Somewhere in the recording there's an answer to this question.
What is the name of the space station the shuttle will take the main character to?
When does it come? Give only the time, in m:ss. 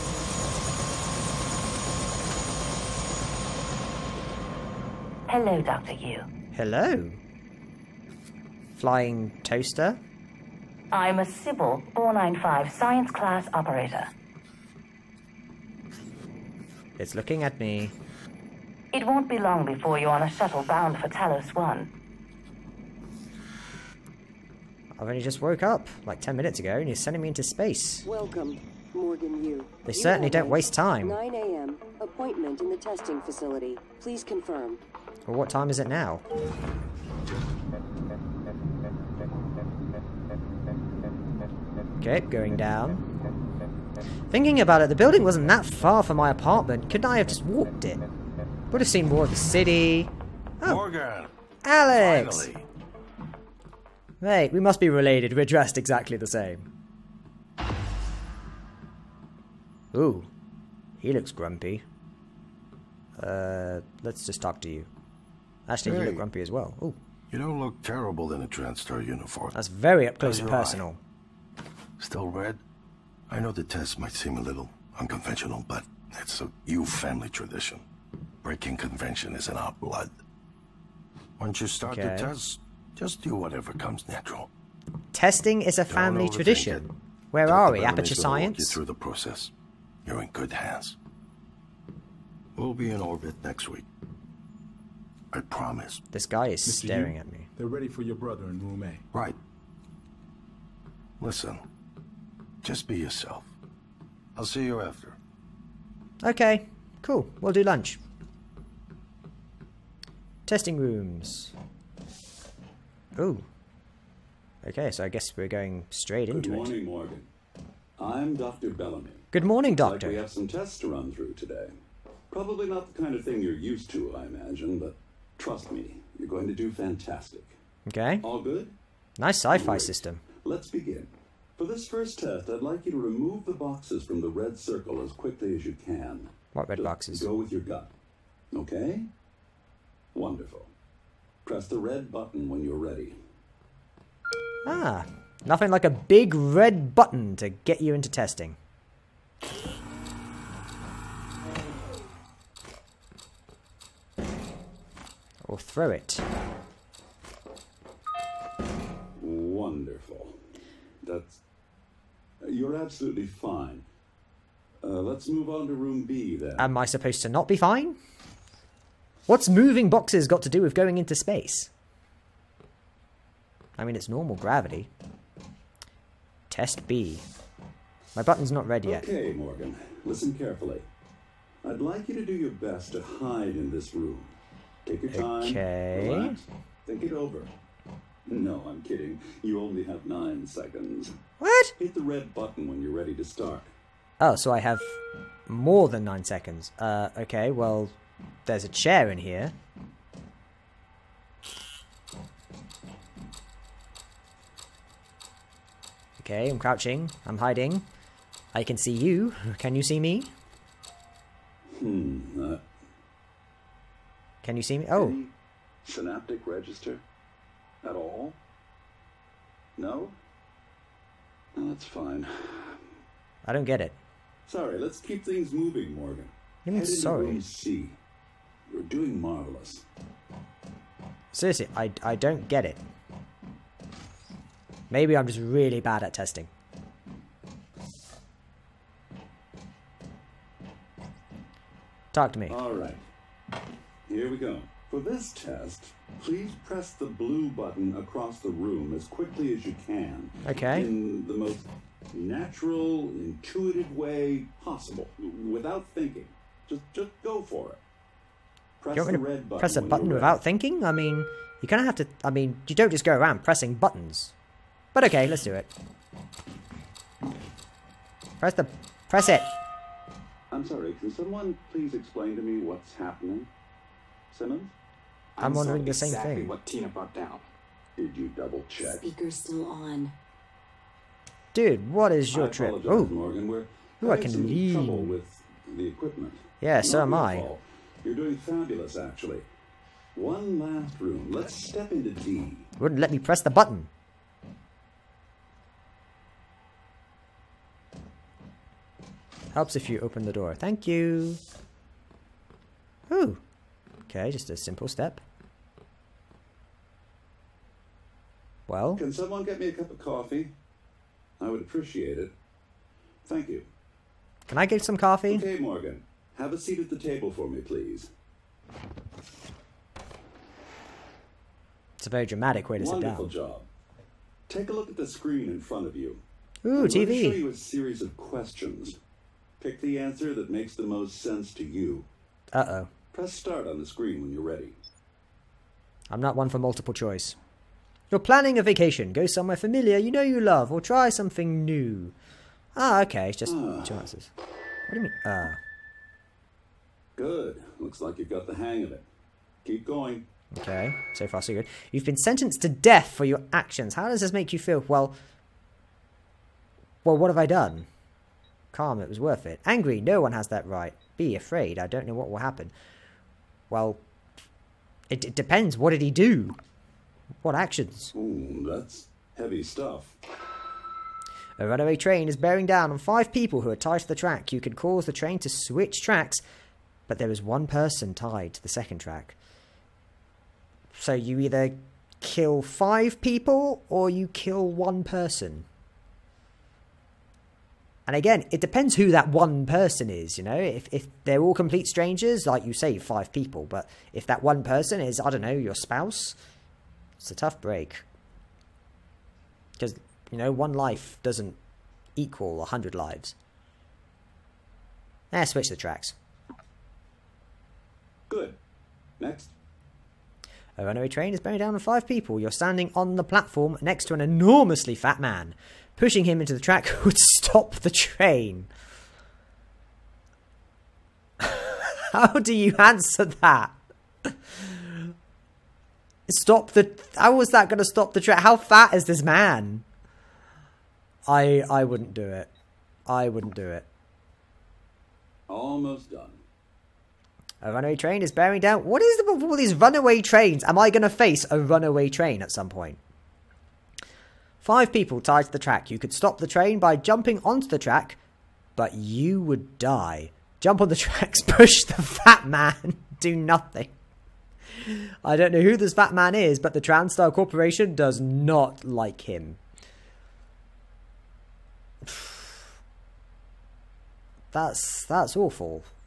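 0:21.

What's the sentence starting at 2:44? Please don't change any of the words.
Uh, let's move on to room B then.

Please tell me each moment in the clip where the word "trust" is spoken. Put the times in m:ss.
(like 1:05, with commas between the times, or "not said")
2:05.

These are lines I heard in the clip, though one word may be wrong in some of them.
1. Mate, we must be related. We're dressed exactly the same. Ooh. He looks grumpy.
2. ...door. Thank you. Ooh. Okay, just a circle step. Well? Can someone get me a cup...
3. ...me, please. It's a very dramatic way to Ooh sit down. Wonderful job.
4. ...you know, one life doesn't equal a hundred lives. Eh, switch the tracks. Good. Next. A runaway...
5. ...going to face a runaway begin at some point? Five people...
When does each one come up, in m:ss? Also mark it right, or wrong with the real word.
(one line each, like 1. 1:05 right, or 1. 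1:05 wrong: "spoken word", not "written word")
1. 0:54 right
2. 5:00 wrong: "simple", not "circle"
3. 5:17 wrong: "Wonderful", not "Ooh"
4. 6:40 right
5. 7:20 wrong: "train", not "begin".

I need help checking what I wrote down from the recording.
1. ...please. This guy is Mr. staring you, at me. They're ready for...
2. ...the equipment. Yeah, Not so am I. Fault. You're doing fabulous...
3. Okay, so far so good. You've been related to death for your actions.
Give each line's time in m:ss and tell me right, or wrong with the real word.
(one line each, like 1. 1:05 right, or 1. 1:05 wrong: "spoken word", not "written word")
1. 1:35 wrong: "promise", not "please"
2. 4:45 right
3. 5:50 wrong: "sentenced", not "related".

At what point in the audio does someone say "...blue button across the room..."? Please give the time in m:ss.
4:07.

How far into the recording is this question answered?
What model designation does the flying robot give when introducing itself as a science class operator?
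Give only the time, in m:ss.
0:11.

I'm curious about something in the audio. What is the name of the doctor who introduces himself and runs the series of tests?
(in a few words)
Dr. Bellamy.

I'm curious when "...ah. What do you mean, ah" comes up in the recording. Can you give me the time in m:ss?
5:43.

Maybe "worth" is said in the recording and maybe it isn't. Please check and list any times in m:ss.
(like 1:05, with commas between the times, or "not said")
5:59.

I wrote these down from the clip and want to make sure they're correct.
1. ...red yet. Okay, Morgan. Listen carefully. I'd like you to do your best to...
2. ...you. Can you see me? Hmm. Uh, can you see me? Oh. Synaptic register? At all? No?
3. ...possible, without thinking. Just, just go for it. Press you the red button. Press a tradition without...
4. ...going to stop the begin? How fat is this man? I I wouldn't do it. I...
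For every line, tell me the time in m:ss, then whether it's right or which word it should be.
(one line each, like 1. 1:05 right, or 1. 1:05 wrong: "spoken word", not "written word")
1. 2:58 right
2. 3:28 right
3. 4:14 wrong: "button", not "tradition"
4. 7:07 wrong: "train", not "begin".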